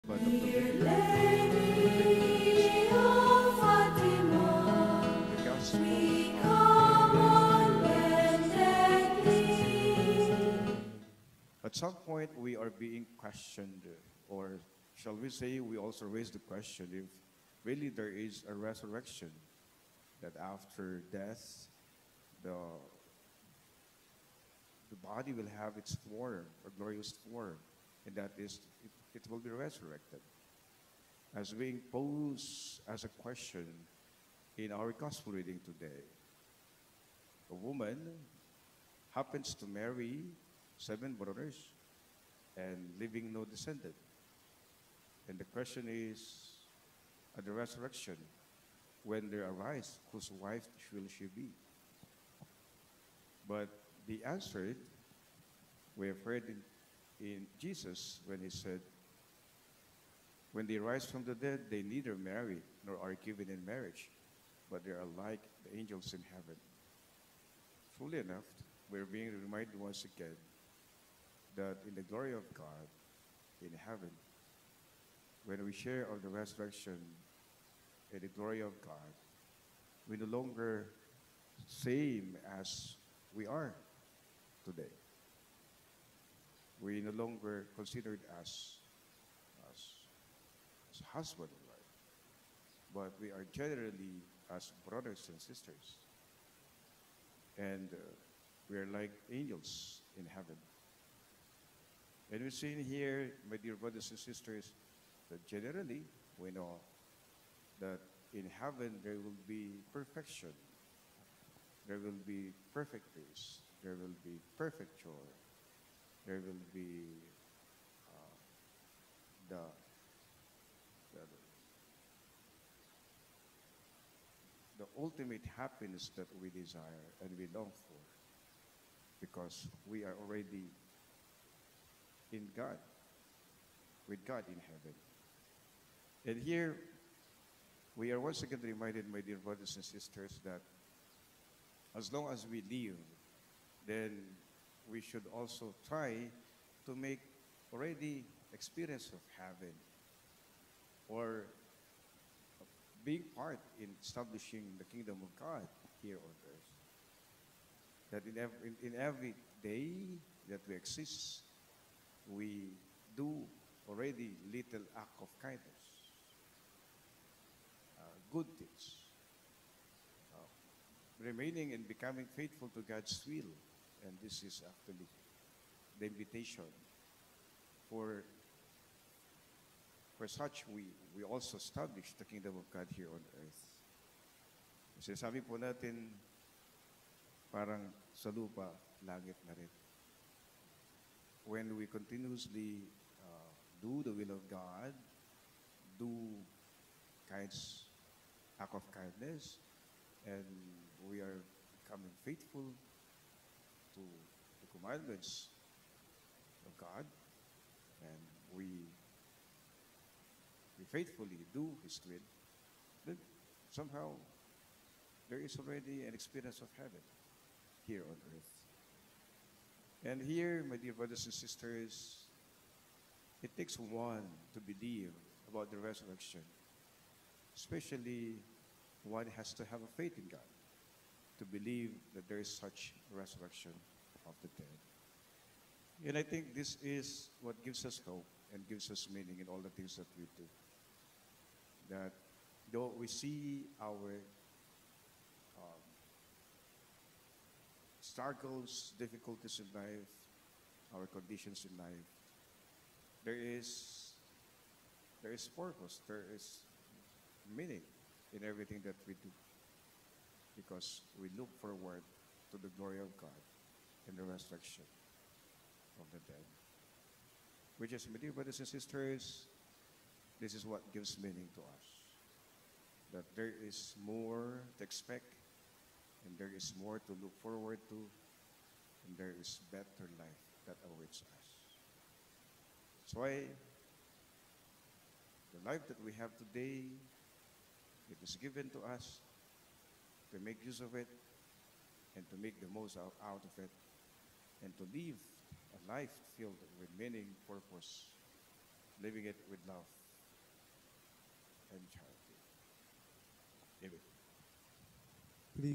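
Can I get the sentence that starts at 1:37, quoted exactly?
And uh, we are like angels in heaven.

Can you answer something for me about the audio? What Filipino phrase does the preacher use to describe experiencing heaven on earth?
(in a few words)
Sinasabi po natin parang sa lupa, langit na rin.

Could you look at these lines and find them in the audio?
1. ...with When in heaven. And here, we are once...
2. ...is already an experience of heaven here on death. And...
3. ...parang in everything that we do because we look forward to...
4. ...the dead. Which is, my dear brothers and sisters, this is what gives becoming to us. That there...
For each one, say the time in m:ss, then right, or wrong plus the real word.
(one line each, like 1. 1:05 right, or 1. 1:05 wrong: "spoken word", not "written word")
1. 2:14 wrong: "God", not "When"
2. 3:35 wrong: "earth", not "death"
3. 4:17 wrong: "meaning", not "parang"
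4. 4:26 wrong: "meaning", not "becoming".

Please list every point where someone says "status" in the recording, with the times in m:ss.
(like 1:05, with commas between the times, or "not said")
not said.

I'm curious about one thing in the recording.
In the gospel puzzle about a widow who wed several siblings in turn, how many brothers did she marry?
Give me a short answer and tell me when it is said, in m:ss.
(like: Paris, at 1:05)
7, at 0:40.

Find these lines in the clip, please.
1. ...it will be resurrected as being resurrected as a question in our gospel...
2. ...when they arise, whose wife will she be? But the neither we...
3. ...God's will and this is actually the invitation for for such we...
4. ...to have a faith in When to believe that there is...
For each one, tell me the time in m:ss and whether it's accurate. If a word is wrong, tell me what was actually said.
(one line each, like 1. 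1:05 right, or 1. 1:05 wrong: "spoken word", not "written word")
1. 0:29 wrong: "posed", not "resurrected"
2. 0:49 wrong: "answer", not "neither"
3. 2:52 right
4. 3:49 wrong: "God", not "When".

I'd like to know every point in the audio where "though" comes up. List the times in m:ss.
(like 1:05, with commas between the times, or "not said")
4:02.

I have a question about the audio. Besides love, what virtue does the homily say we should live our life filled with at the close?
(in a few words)
charity.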